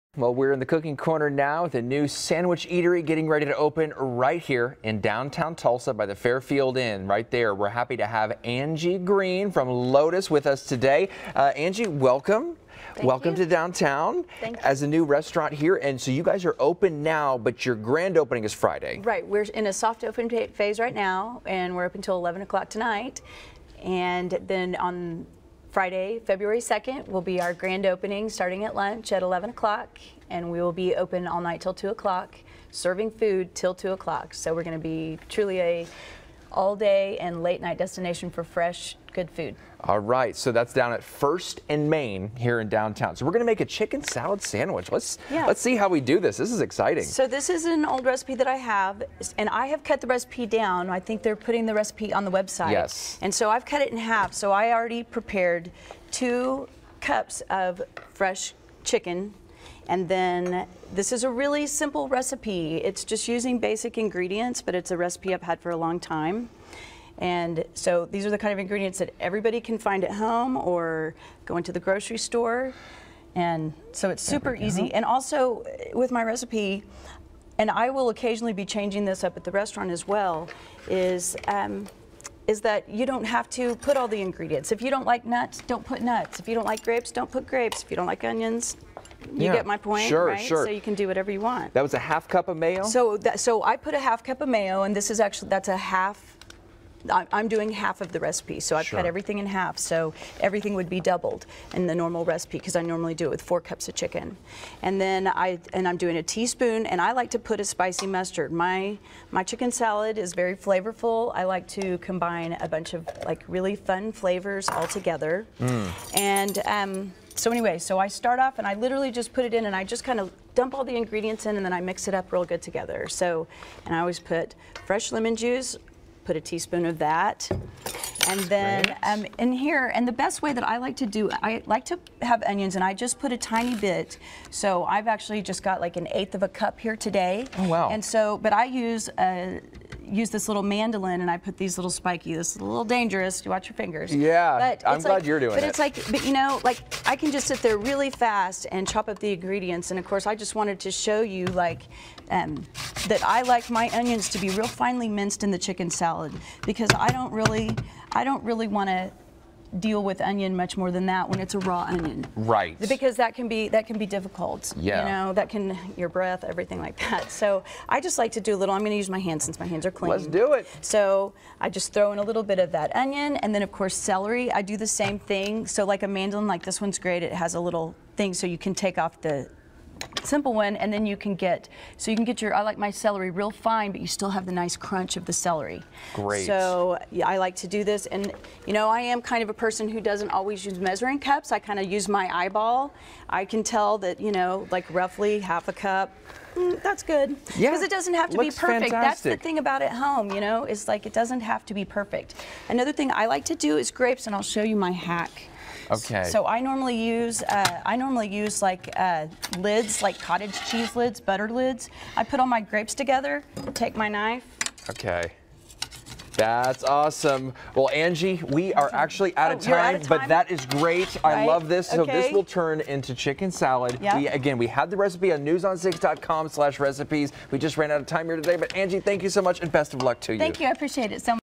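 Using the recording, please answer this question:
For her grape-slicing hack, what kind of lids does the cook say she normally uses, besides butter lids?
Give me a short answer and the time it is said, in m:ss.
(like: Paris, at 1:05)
cottage cheese lids, at 3:30.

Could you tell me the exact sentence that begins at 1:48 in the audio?
My my chicken salad is very flavorful.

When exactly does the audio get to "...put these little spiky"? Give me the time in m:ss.
2:21.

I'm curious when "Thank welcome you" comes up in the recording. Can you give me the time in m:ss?
0:12.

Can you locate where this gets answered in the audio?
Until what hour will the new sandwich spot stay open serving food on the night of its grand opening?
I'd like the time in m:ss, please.
0:32.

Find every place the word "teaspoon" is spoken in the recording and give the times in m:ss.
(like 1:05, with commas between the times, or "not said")
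1:46, 2:06.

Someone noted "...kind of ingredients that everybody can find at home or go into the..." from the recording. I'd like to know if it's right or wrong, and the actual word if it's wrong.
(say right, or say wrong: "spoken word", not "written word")
right.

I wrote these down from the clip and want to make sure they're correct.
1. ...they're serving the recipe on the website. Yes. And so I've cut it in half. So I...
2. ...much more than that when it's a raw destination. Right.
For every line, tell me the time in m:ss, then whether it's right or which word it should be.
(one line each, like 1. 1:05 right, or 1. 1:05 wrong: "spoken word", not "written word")
1. 0:51 wrong: "putting", not "serving"
2. 2:40 wrong: "onion", not "destination".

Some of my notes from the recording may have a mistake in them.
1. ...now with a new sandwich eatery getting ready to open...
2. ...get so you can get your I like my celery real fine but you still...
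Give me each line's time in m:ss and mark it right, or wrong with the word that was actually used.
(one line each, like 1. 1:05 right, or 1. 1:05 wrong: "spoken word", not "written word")
1. 0:01 right
2. 3:01 right.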